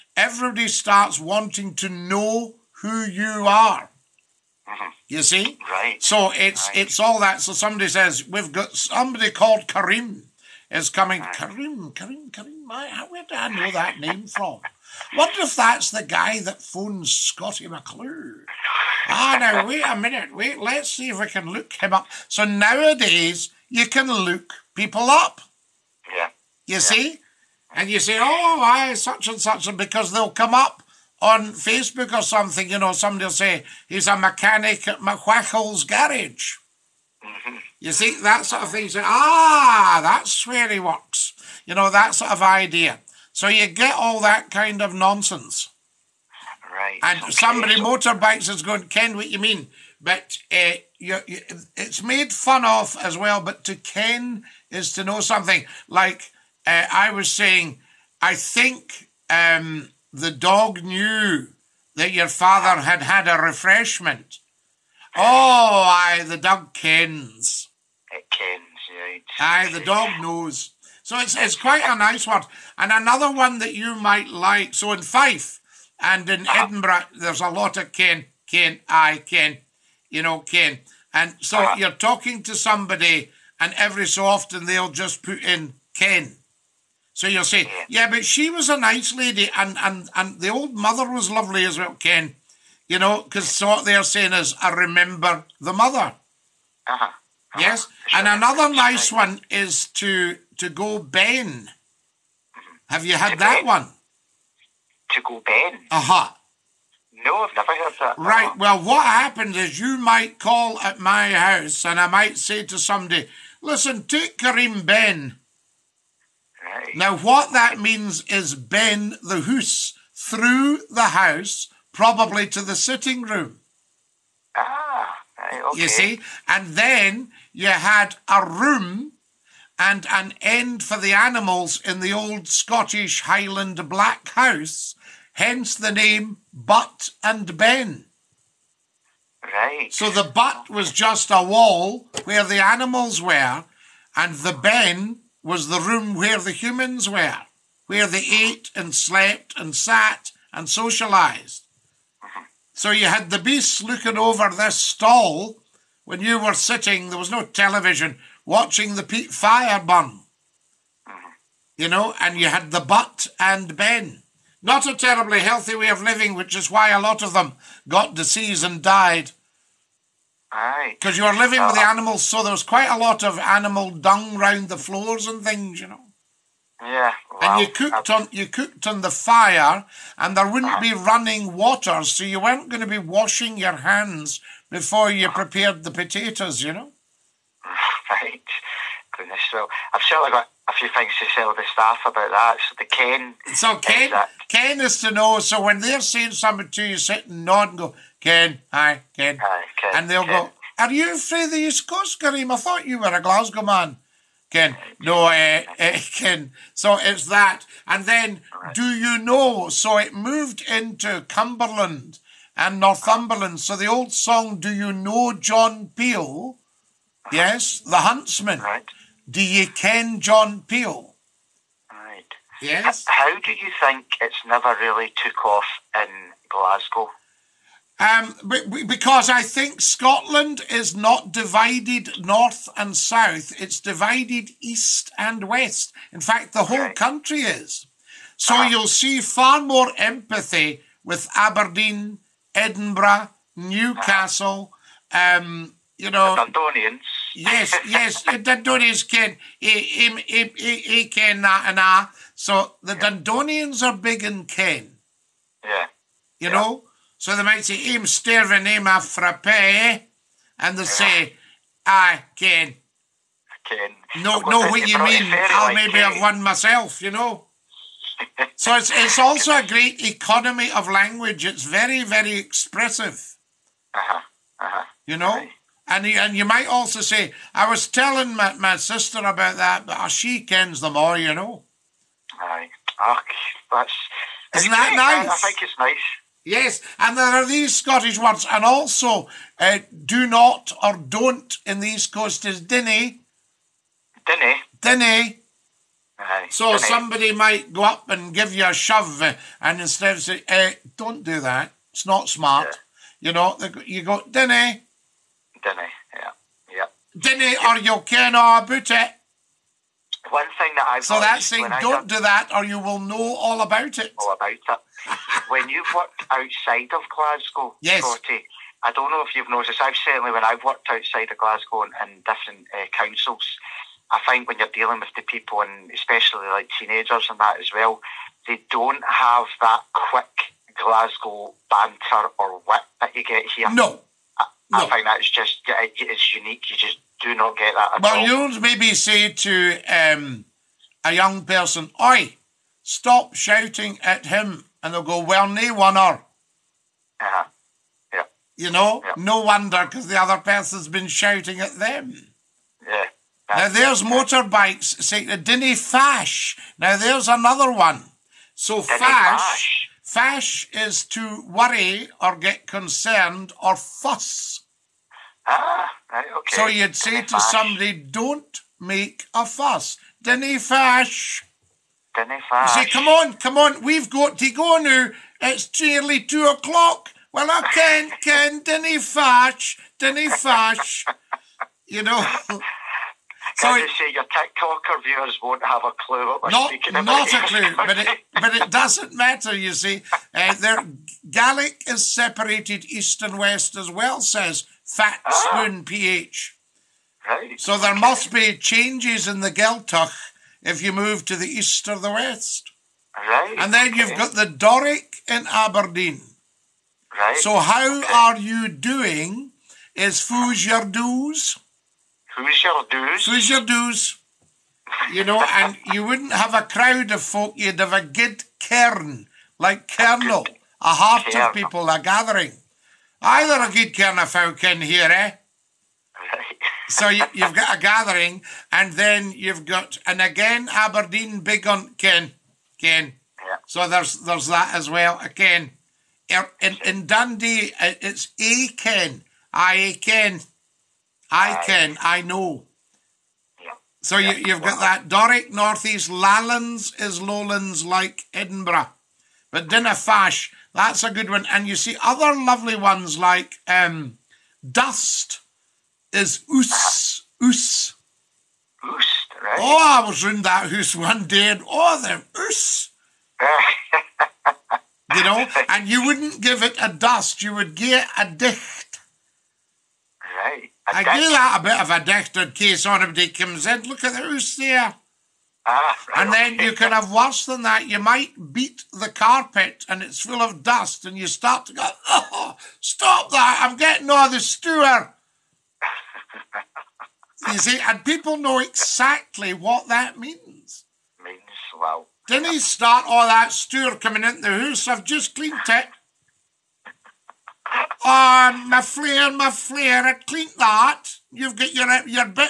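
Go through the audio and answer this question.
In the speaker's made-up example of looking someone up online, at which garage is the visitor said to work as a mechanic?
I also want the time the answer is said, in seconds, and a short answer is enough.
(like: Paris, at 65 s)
McWhackle's garage, at 34 s.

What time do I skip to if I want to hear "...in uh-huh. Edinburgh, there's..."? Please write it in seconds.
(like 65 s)
76 s.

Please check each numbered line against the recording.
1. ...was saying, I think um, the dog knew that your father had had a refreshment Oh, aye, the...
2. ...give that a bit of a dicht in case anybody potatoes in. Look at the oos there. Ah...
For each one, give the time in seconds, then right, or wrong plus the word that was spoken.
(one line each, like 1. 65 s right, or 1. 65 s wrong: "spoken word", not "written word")
1. 57 s right
2. 471 s wrong: "comes", not "potatoes".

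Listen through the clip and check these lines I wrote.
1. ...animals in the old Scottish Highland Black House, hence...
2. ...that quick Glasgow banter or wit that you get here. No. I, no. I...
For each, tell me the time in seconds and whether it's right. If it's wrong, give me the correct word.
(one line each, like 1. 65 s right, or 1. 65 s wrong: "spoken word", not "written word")
1. 131 s right
2. 329 s right.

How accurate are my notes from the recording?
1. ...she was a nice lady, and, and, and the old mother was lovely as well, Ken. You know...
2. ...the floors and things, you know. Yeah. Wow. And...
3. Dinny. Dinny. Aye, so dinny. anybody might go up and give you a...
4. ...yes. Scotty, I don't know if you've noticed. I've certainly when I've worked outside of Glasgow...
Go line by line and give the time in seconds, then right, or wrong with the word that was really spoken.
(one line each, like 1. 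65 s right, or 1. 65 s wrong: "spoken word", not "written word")
1. 88 s right
2. 174 s right
3. 294 s wrong: "somebody", not "anybody"
4. 317 s right.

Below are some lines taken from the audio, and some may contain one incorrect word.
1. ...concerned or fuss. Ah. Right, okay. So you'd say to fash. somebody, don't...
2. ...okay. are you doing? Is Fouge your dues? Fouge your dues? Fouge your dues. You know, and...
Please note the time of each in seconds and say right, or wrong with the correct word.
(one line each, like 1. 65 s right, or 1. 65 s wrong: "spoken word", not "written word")
1. 362 s right
2. 407 s right.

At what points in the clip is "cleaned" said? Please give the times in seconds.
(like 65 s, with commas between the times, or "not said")
495 s, 500 s.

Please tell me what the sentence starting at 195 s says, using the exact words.
So when they're saying something to you, sit and nod and go, Ken, hi, Ken, hi, Ken and they'll Ken.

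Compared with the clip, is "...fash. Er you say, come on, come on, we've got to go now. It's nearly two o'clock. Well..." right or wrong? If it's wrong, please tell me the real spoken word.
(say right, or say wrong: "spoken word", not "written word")
right.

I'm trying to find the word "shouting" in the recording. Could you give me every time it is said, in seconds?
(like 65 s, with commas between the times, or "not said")
343 s, 351 s.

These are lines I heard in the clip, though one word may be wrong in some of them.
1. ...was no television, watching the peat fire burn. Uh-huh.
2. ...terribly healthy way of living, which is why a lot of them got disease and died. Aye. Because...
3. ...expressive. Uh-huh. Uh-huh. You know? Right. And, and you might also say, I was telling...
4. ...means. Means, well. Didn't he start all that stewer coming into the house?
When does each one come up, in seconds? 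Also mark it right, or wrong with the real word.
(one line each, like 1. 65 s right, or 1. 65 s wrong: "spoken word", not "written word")
1. 157 s right
2. 164 s right
3. 272 s right
4. 490 s right.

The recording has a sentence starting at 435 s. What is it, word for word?
Again, er, in, in Dundee, uh, it's A Ken.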